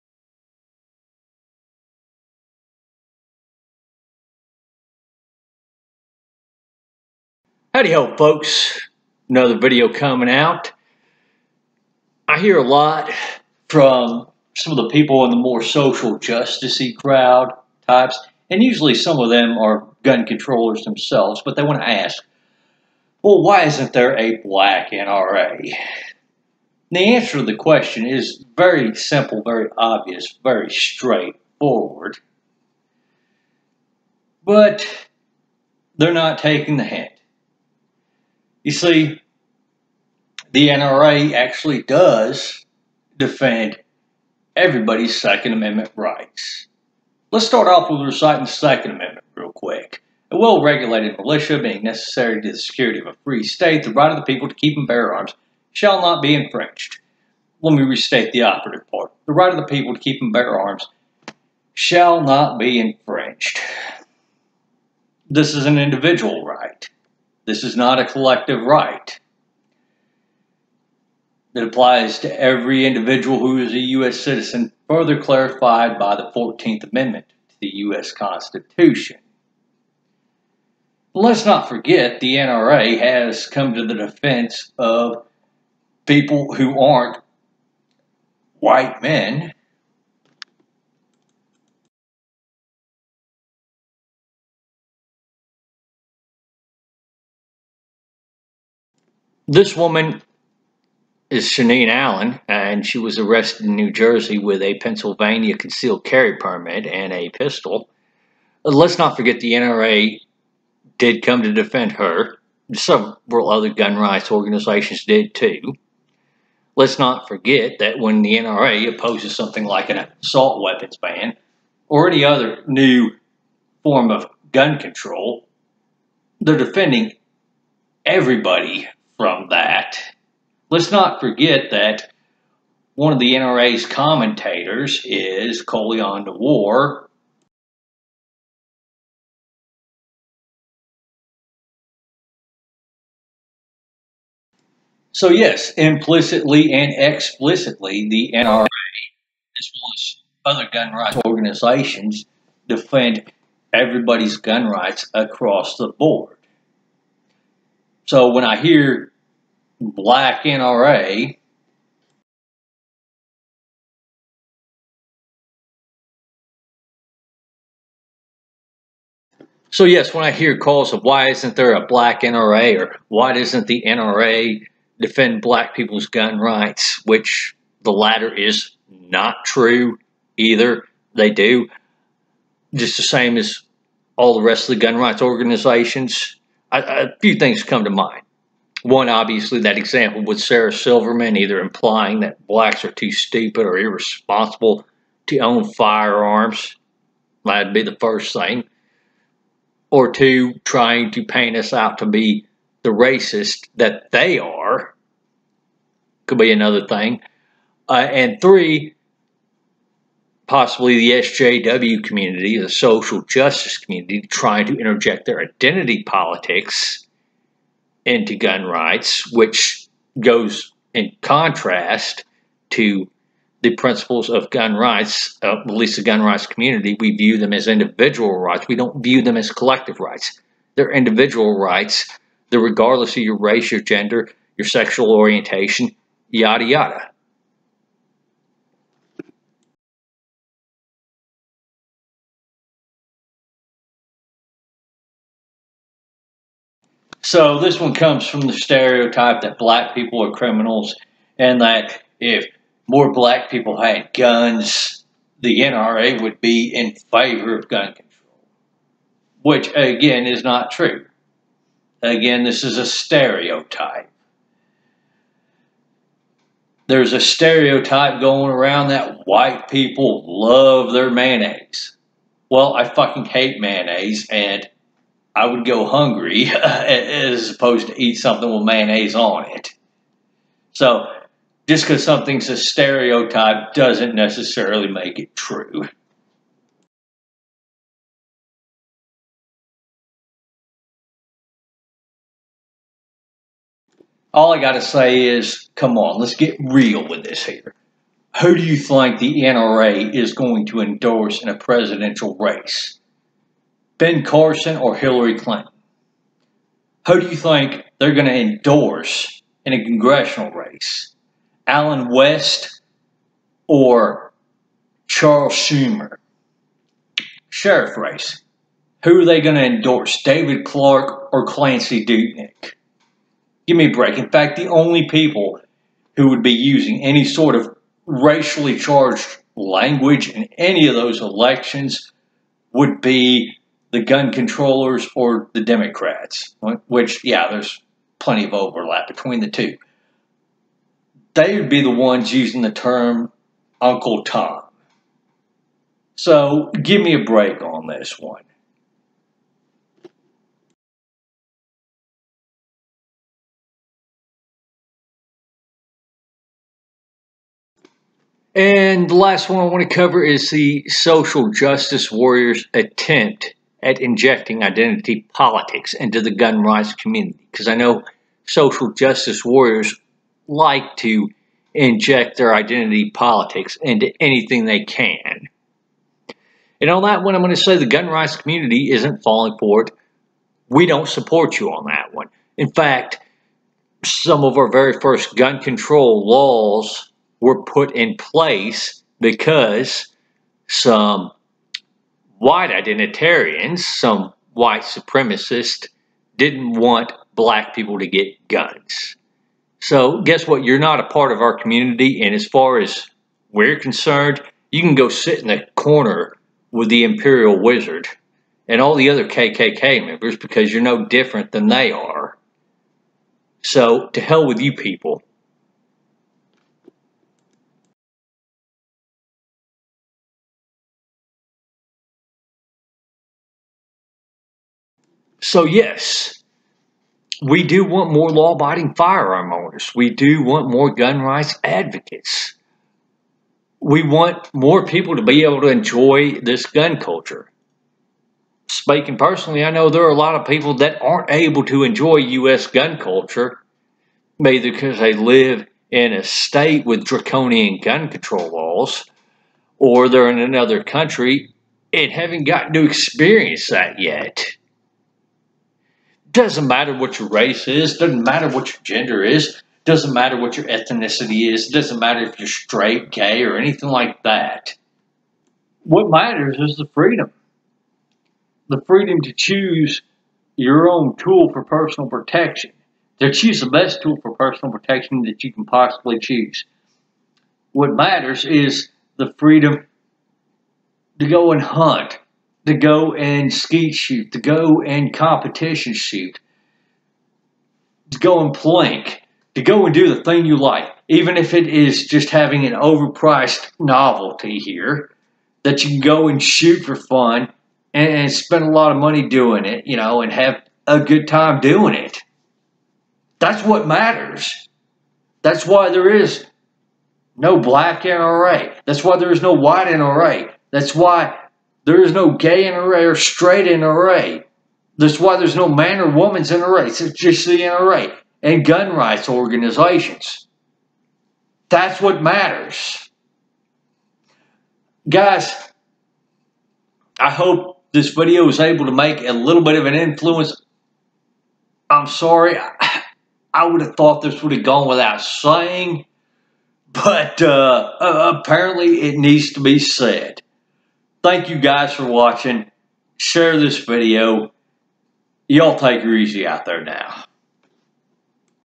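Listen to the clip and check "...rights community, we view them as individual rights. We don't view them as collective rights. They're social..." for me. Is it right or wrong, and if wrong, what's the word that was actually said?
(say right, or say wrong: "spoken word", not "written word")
wrong: "individual", not "social".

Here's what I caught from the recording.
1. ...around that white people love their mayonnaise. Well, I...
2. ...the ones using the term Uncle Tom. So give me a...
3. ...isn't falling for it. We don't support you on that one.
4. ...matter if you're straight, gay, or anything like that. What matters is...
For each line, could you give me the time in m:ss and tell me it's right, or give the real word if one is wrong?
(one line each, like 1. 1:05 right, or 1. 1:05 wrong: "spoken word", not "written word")
1. 4:28 right
2. 5:41 right
3. 6:18 right
4. 7:41 right.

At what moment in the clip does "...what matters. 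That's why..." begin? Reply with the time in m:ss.
8:23.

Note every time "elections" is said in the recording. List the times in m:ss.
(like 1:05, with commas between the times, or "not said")
5:31.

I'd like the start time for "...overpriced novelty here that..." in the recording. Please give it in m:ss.
8:12.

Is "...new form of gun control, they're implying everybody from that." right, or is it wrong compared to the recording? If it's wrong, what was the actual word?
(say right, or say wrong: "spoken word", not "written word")
wrong: "defending", not "implying".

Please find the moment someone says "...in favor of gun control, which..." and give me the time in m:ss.
4:16.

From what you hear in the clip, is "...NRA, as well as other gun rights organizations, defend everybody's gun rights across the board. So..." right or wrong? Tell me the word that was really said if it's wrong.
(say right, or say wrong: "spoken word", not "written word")
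right.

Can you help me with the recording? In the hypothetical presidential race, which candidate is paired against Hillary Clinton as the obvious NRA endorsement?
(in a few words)
Ben Carson.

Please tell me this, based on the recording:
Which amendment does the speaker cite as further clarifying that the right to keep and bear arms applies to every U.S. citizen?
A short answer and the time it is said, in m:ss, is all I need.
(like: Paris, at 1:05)
14th Amendment, at 1:16.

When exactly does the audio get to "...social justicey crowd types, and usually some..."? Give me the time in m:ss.
0:15.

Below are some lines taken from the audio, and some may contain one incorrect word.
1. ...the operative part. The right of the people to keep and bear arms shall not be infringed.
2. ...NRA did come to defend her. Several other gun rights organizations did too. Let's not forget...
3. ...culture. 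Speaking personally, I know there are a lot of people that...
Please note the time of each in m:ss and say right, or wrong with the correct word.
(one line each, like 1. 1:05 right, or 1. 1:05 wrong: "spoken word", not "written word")
1. 0:58 right
2. 1:49 right
3. 7:16 right.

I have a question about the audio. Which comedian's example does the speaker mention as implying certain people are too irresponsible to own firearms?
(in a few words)
Sarah Silverman.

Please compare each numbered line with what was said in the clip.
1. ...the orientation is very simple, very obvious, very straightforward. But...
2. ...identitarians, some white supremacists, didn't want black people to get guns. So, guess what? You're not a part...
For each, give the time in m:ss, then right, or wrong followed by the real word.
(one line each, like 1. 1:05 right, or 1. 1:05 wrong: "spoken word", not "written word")
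1. 0:27 wrong: "question", not "orientation"
2. 6:32 right.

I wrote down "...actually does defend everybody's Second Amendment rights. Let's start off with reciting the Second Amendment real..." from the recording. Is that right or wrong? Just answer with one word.
right.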